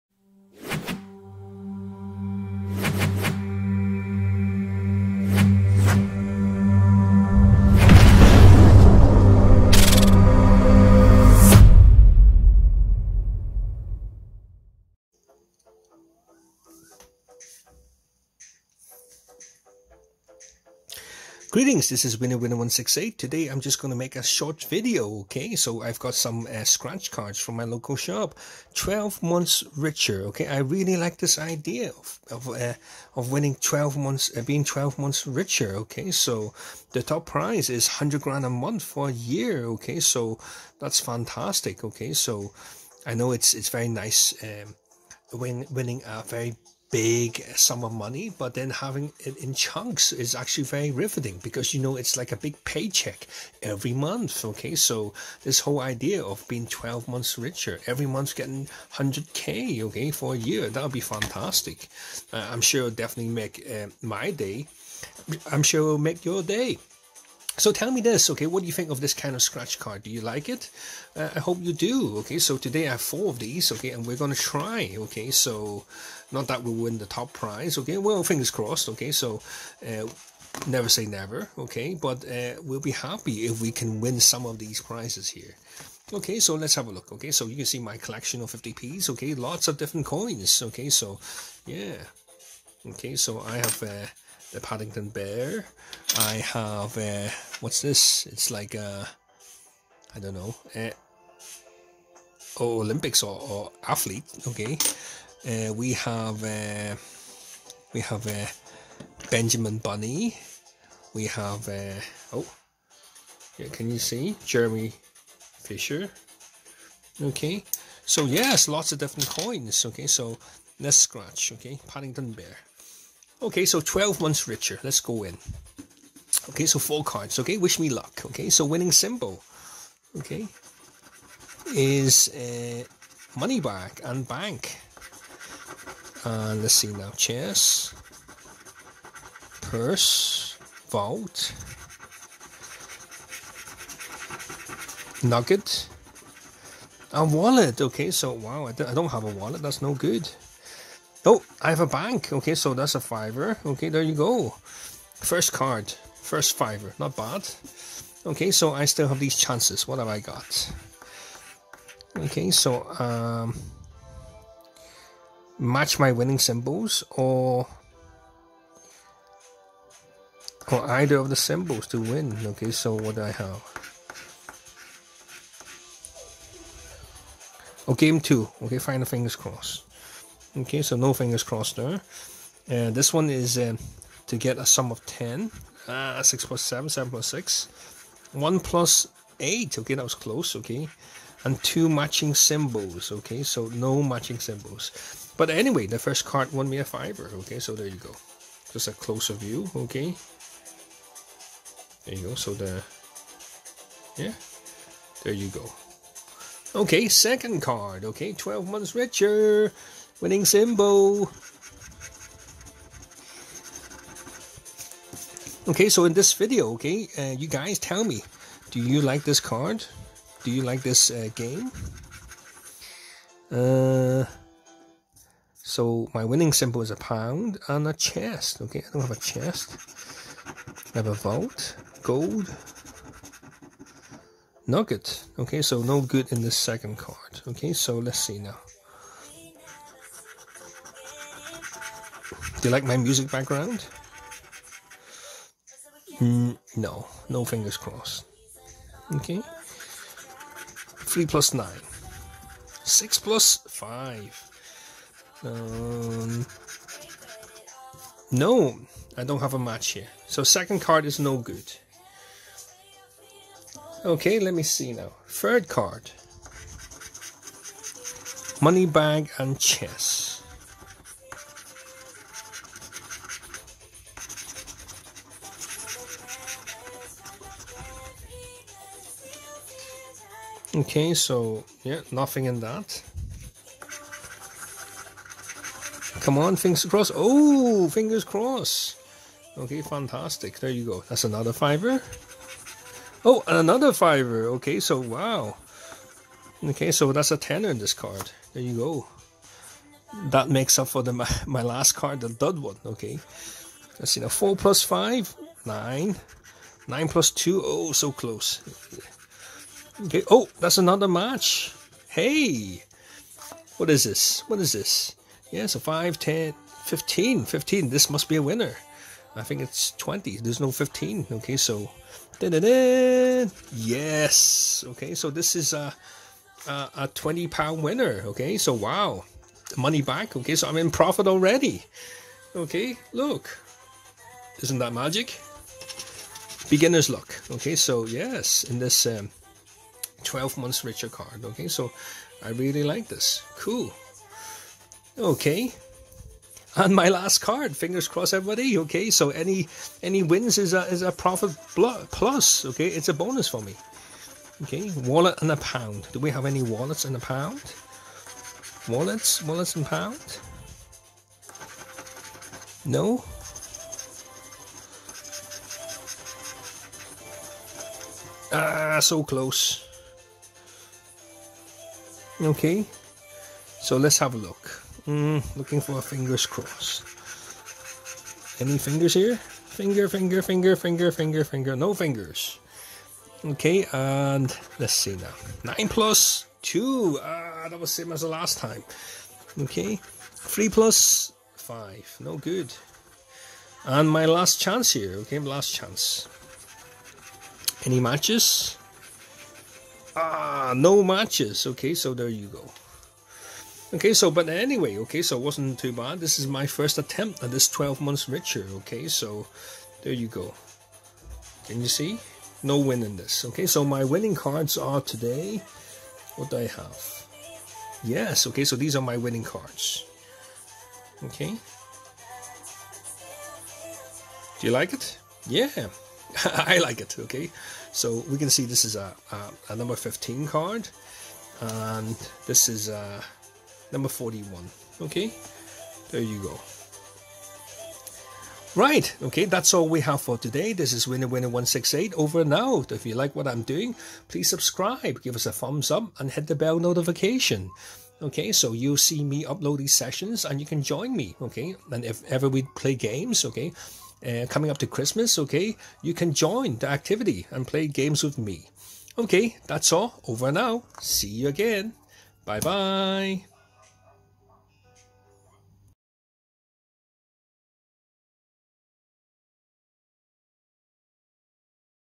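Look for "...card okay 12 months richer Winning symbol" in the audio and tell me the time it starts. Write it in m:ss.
3:27.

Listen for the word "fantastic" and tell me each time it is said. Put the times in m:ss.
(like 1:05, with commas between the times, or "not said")
0:41, 1:00, 4:49.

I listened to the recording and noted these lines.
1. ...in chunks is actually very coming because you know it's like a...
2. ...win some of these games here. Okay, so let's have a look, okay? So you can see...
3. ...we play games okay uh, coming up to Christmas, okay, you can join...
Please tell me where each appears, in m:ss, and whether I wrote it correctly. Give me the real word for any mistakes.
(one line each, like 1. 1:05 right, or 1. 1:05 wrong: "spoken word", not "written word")
1. 0:49 wrong: "riveting", not "coming"
2. 1:24 wrong: "prizes", not "games"
3. 7:32 right.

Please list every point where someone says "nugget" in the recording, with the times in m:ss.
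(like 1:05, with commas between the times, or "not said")
2:25, 3:54.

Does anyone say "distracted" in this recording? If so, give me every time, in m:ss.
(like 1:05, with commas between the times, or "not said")
not said.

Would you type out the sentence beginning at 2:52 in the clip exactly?
Okay, so what do I have?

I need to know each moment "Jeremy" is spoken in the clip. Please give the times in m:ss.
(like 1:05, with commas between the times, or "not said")
1:54.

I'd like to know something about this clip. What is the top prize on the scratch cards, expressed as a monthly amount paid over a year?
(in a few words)
100 grand a month.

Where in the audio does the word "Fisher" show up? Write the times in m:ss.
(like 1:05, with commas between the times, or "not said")
1:55.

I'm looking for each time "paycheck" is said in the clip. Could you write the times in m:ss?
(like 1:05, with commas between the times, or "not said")
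0:52.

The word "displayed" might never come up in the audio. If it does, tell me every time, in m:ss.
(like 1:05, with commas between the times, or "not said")
not said.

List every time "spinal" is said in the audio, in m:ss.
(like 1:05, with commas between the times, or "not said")
not said.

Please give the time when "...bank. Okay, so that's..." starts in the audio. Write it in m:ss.
2:31.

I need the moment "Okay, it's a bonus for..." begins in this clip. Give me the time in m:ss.
5:52.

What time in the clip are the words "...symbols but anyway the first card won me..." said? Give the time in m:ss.
3:14.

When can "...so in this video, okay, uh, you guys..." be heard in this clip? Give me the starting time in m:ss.
3:35.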